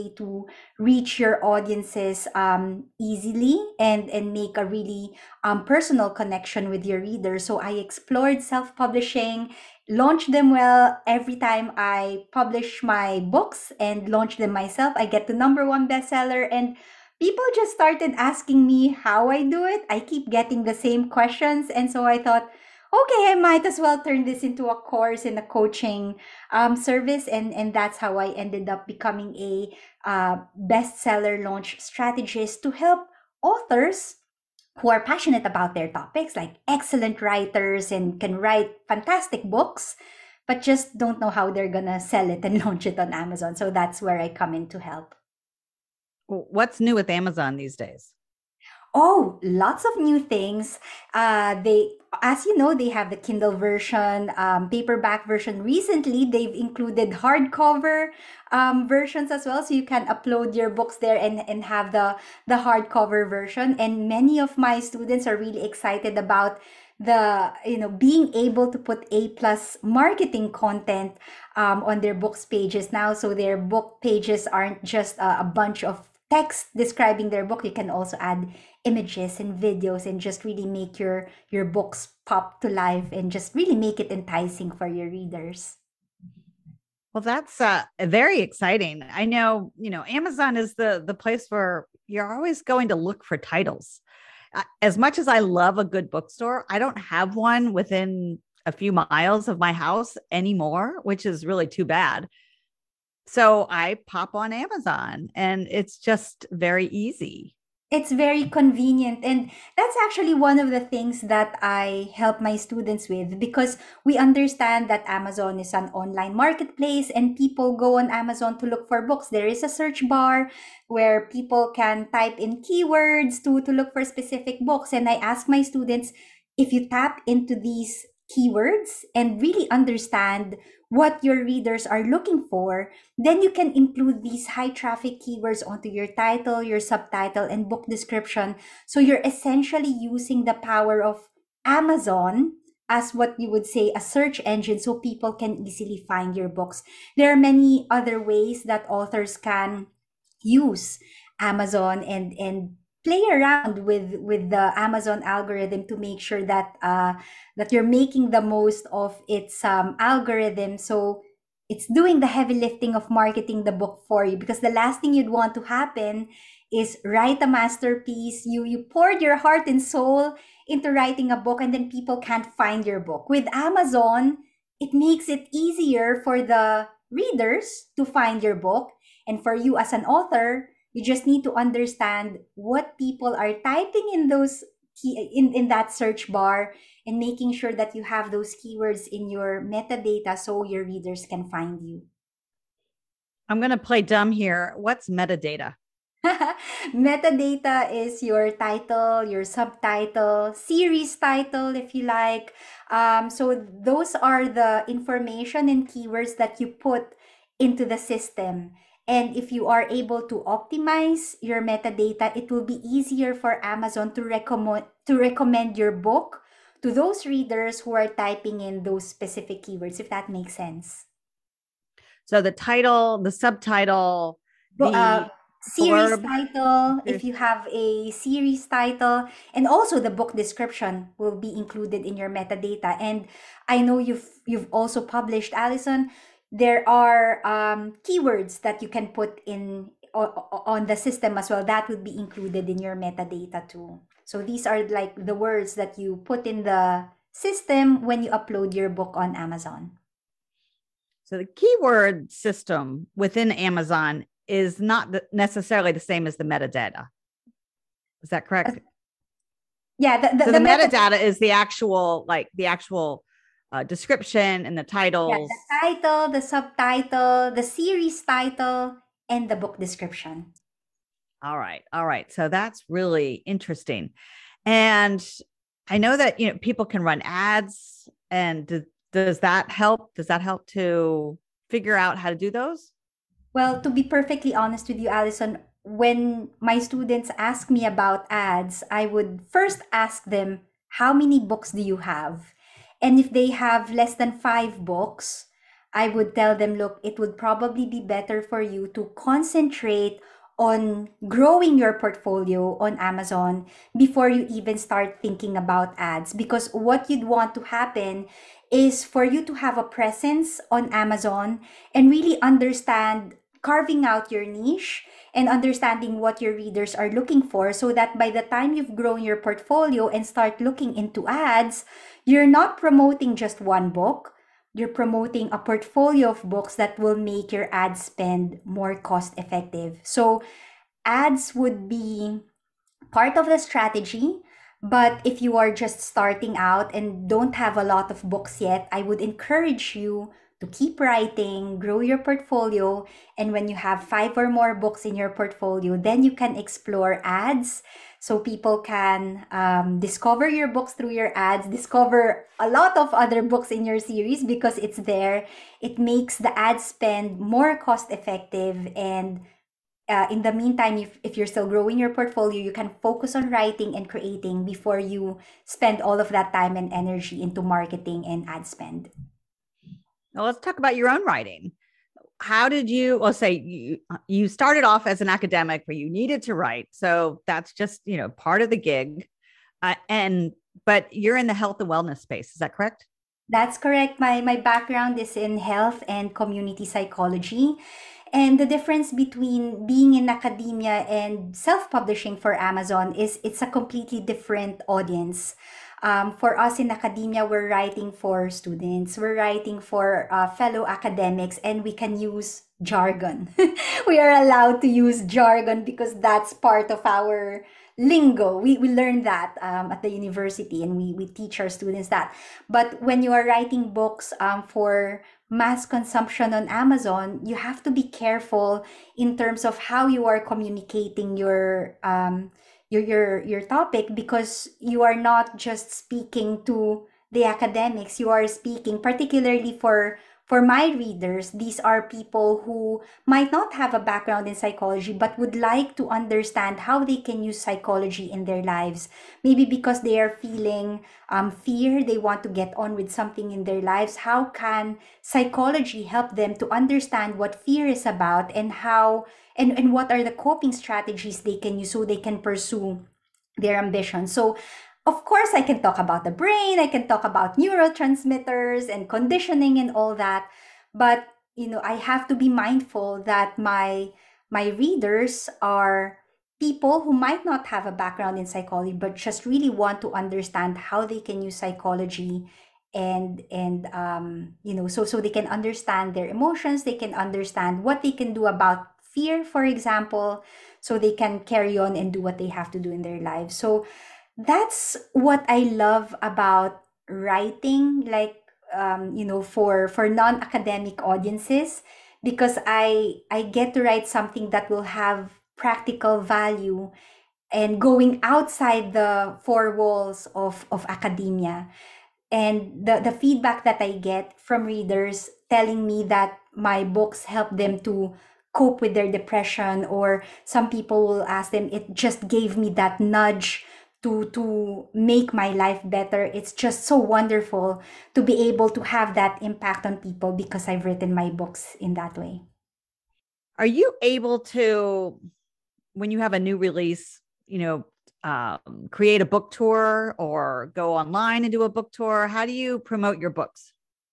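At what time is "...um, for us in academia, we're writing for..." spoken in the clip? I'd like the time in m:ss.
6:36.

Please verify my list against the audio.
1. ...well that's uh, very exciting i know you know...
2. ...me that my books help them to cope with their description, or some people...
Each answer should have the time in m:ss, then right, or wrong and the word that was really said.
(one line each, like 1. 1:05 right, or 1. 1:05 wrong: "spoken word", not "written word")
1. 1:27 right
2. 8:25 wrong: "depression", not "description".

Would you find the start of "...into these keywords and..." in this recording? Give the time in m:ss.
2:07.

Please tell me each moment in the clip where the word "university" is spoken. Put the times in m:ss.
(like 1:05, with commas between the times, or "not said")
6:50.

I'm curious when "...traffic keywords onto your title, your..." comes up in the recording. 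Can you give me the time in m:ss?
2:14.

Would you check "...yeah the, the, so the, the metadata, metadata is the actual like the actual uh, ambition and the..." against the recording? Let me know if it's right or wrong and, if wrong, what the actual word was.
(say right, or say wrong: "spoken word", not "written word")
wrong: "description", not "ambition".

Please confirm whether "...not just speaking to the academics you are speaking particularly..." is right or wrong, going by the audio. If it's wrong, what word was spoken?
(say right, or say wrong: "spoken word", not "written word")
right.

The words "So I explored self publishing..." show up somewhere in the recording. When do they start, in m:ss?
0:07.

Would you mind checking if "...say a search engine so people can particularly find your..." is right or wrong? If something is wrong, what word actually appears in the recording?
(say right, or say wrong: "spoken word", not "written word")
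wrong: "easily", not "particularly".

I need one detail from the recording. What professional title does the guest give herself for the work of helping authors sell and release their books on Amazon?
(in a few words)
bestseller launch strategist.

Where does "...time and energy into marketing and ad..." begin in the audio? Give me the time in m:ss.
6:06.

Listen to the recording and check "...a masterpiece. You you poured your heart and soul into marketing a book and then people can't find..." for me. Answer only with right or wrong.
wrong.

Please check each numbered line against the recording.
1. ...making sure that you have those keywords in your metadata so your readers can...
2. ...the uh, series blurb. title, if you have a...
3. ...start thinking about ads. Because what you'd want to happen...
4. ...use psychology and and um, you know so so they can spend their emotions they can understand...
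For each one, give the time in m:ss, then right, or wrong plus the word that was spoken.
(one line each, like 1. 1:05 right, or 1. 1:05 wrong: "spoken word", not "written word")
1. 3:07 right
2. 3:44 right
3. 5:04 right
4. 7:51 wrong: "understand", not "spend".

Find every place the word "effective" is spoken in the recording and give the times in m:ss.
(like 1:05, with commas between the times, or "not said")
5:29, 5:58.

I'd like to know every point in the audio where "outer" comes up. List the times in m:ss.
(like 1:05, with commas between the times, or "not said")
not said.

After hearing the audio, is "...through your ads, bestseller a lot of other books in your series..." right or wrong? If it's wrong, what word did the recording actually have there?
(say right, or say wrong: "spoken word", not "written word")
wrong: "discover", not "bestseller".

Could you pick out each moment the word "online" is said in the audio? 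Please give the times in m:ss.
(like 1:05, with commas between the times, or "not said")
1:55, 8:50.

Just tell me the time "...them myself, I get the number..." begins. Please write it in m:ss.
0:14.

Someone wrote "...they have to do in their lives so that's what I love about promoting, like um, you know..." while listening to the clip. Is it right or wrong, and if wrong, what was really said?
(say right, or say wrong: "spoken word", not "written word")
wrong: "writing", not "promoting".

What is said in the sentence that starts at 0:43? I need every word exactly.
So that's where I come in to help.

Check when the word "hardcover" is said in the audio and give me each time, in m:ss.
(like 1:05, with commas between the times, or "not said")
0:57, 1:02.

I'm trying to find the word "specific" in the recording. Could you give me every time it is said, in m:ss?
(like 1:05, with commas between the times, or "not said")
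2:04, 3:39.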